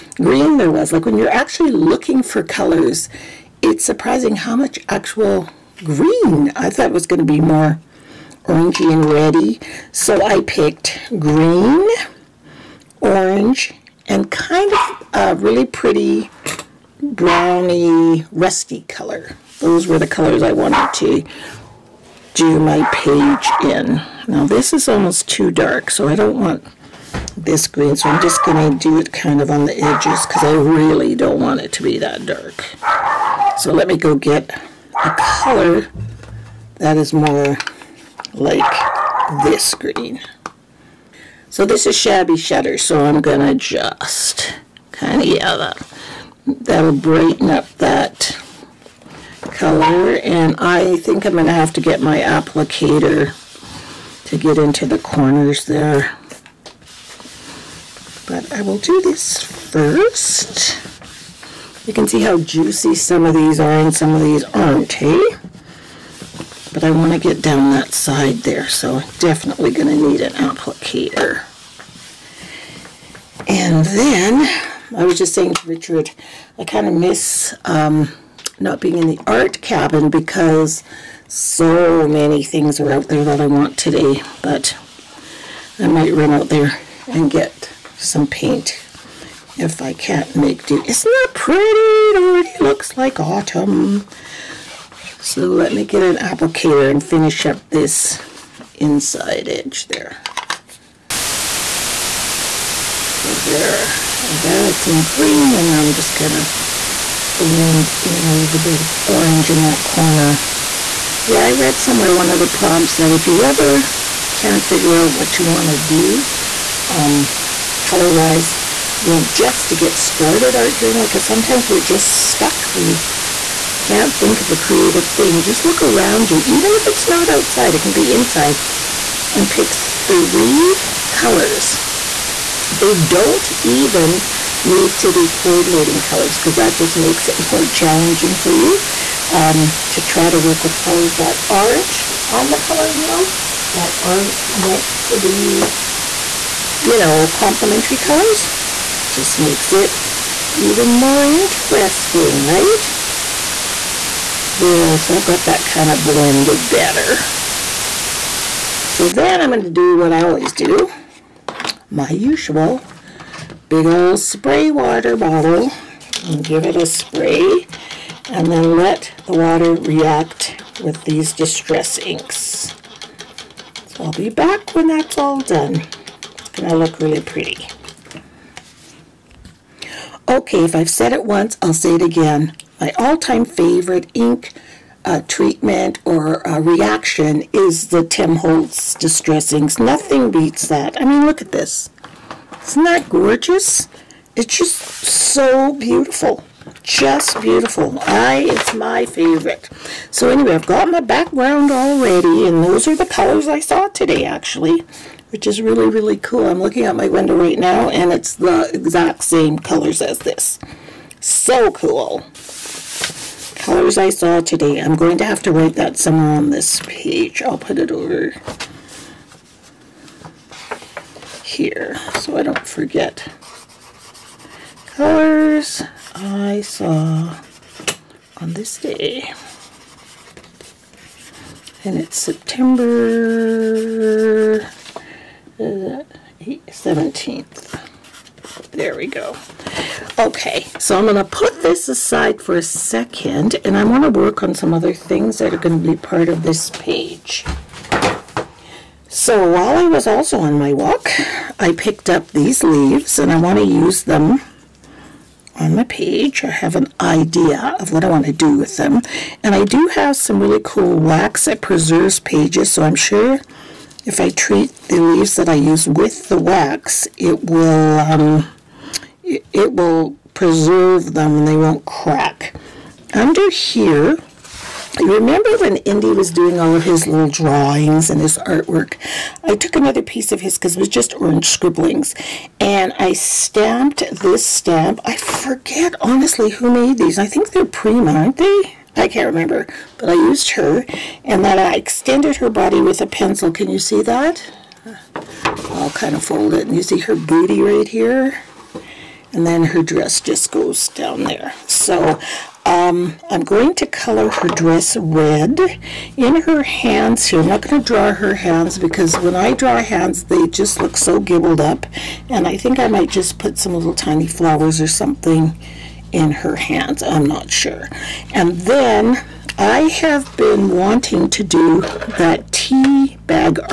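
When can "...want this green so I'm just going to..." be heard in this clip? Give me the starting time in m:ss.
0:26.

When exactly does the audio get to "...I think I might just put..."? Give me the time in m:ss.
5:12.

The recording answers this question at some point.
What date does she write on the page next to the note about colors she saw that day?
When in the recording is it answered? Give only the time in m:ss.
3:52.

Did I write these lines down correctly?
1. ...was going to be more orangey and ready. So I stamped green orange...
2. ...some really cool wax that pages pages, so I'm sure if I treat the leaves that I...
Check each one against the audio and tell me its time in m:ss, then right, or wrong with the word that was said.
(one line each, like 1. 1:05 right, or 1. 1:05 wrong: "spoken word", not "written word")
1. 0:06 wrong: "picked", not "stamped"
2. 4:20 wrong: "preserves", not "pages".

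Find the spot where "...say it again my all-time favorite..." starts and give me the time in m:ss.
3:01.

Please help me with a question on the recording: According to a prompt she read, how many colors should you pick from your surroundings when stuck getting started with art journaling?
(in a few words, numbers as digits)
3.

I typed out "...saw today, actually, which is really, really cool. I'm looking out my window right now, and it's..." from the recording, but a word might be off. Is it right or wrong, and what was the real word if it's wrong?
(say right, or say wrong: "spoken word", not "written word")
right.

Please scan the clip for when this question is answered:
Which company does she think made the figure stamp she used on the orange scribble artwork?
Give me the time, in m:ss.
4:47.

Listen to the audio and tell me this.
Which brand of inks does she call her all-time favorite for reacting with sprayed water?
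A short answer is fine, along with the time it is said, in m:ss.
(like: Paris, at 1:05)
Tim Holtz Distress Inks, at 3:08.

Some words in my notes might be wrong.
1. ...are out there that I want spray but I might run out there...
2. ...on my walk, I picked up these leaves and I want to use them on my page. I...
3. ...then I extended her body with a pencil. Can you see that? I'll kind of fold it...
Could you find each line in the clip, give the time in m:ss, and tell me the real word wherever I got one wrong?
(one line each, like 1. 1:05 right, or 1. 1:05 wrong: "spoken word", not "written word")
1. 1:22 wrong: "today", not "spray"
2. 4:10 right
3. 4:51 right.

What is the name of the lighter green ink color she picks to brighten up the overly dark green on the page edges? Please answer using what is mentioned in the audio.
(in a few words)
Shabby Shutter.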